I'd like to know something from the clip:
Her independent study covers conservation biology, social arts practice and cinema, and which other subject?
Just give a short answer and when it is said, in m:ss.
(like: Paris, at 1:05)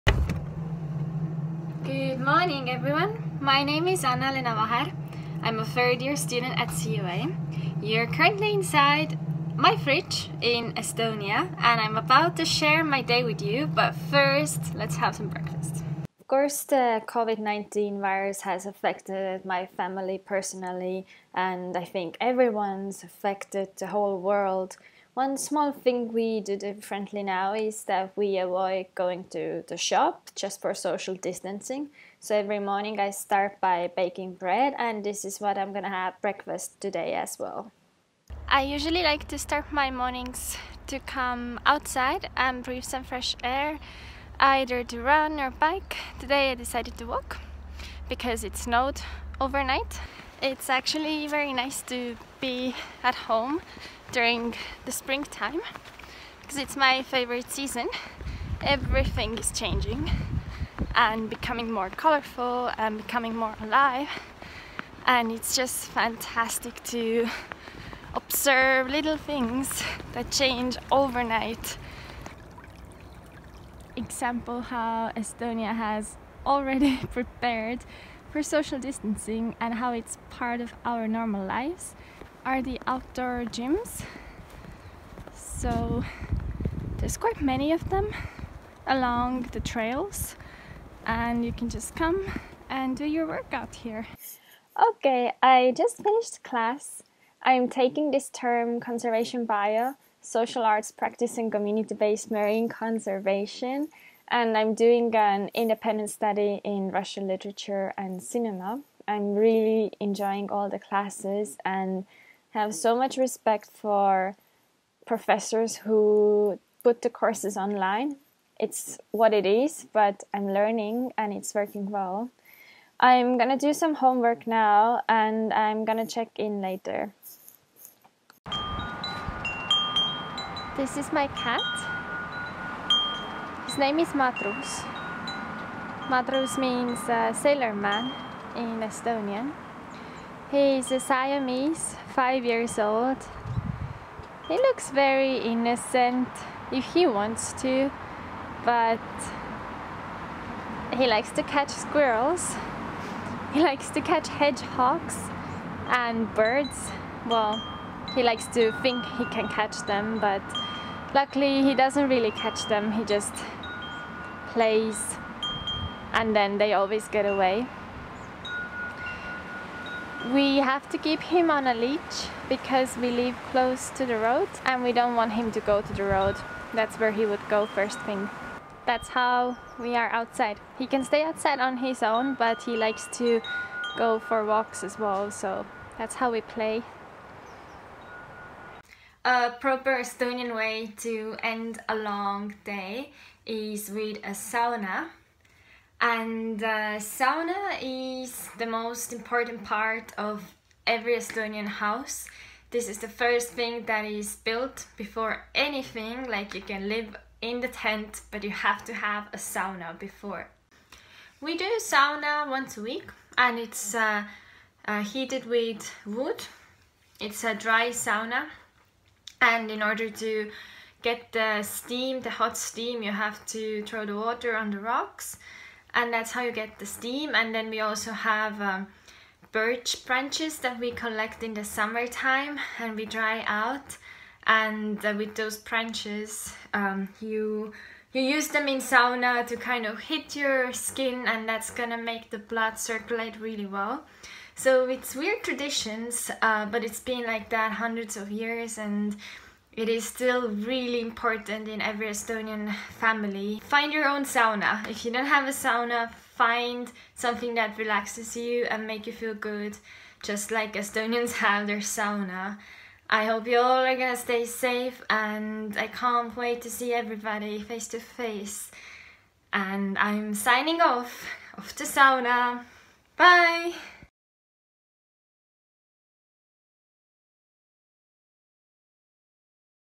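Russian literature, at 1:46.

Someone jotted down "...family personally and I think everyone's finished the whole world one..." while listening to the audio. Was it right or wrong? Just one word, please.
wrong.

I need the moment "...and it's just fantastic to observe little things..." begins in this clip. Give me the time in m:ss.
1:05.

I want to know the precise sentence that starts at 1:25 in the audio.
So there's quite many of them along the trails and you can just come and do your workout here.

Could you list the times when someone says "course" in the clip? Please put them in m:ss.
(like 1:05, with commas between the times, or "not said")
0:16, 1:57.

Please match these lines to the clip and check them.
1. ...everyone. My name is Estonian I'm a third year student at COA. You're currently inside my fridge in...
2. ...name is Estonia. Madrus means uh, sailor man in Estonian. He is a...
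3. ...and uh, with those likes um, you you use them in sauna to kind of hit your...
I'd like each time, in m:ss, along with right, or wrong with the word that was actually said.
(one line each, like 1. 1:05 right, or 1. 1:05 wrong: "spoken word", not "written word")
1. 0:02 wrong: "Annaleena", not "Estonian"
2. 2:13 wrong: "Madrus", not "Estonia"
3. 3:54 wrong: "branches", not "likes".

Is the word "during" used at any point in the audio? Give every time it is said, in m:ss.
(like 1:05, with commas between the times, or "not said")
0:54.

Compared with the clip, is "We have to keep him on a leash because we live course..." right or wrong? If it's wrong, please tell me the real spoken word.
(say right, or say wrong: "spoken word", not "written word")
wrong: "close", not "course".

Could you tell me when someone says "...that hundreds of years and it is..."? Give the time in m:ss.
4:07.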